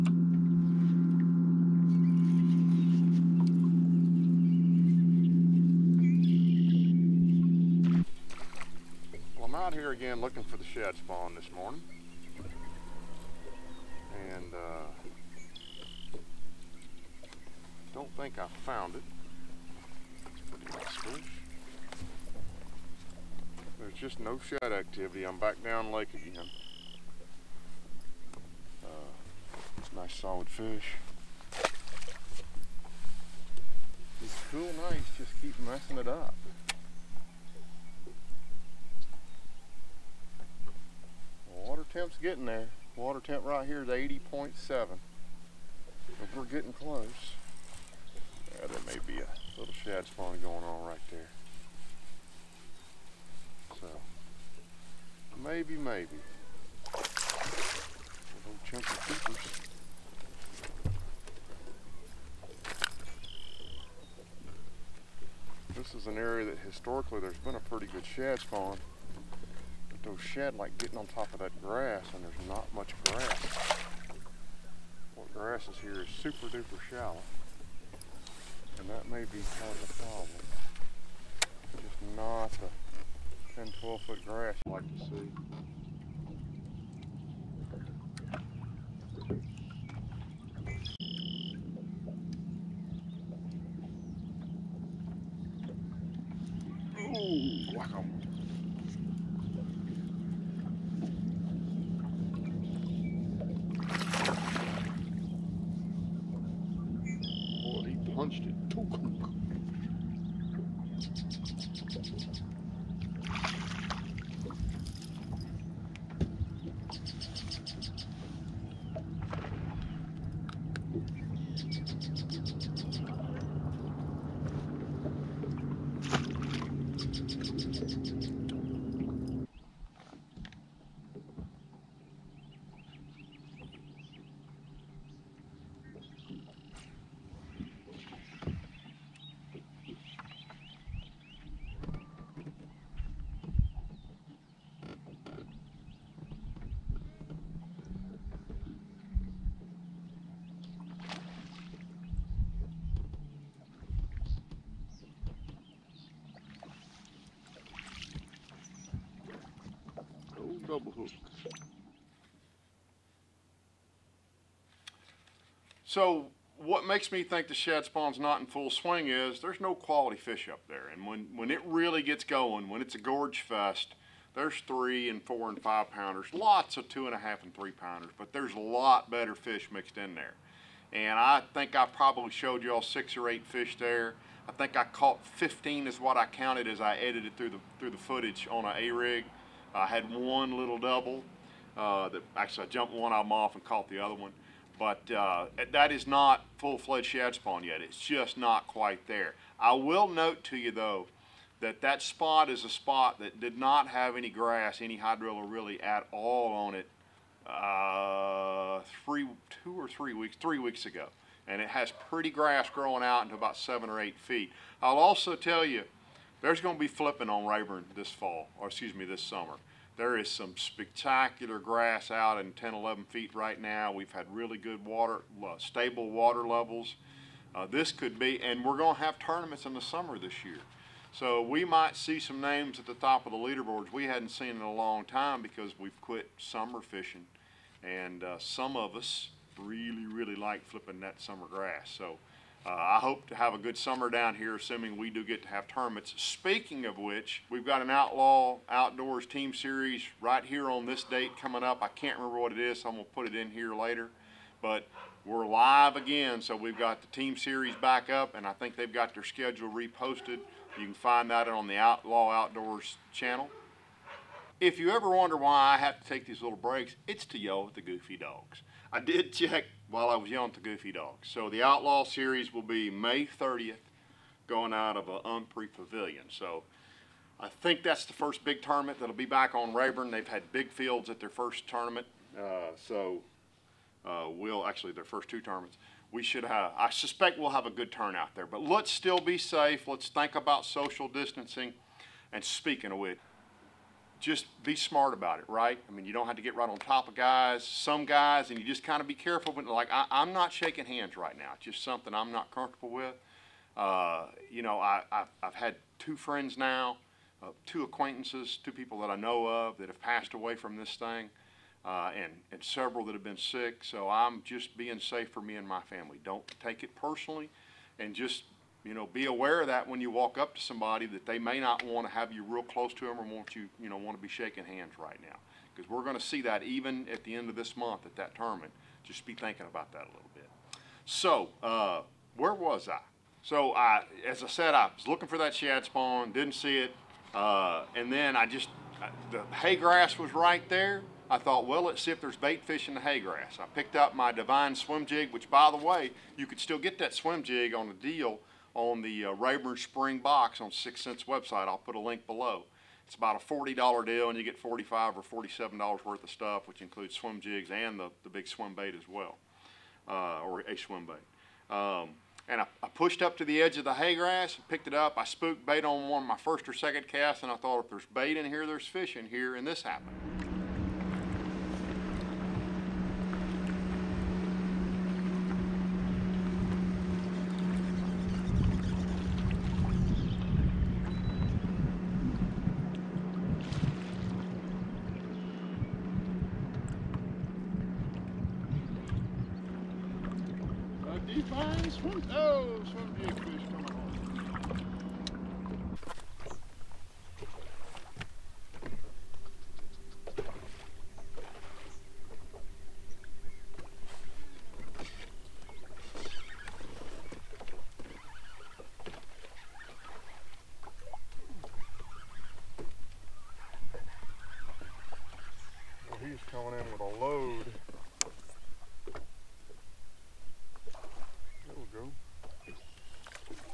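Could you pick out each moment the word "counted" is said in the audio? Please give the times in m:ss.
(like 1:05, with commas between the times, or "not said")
3:06.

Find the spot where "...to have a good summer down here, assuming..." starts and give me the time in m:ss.
4:03.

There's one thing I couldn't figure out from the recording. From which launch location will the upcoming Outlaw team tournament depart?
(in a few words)
Umphrey Pavilion.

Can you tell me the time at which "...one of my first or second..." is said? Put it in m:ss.
6:06.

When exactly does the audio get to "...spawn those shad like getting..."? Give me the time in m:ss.
1:08.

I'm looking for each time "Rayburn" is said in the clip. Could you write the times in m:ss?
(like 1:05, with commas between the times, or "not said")
3:37, 4:39, 5:49.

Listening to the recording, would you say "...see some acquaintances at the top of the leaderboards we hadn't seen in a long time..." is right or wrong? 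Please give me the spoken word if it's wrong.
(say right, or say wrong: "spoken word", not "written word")
wrong: "names", not "acquaintances".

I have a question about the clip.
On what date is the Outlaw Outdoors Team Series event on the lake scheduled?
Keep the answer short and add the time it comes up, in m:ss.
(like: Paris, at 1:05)
May 30th, at 4:32.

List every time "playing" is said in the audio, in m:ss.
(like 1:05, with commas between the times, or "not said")
not said.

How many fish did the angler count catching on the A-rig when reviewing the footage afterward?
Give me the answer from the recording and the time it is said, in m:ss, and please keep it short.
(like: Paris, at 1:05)
15, at 3:05.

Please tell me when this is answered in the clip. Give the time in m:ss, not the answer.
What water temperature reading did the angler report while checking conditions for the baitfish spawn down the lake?
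0:43.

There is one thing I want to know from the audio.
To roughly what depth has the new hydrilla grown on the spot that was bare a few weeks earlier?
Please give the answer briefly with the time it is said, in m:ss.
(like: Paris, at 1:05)
7 or 8 feet, at 3:33.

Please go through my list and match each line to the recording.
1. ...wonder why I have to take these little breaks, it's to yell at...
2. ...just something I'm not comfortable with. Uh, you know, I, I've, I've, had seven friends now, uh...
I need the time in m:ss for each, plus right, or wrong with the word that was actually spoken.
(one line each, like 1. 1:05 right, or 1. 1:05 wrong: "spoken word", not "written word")
1. 4:25 right
2. 5:01 wrong: "two", not "seven".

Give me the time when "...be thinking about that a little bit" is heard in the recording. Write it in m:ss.
5:29.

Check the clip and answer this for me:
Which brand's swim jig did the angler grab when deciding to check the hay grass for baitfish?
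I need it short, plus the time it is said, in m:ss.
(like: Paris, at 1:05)
Divine, at 5:44.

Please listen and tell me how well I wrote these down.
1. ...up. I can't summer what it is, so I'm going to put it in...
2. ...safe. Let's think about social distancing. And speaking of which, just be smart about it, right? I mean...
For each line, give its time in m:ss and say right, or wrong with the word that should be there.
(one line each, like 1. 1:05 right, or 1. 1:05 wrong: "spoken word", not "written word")
1. 4:11 wrong: "remember", not "summer"
2. 4:49 right.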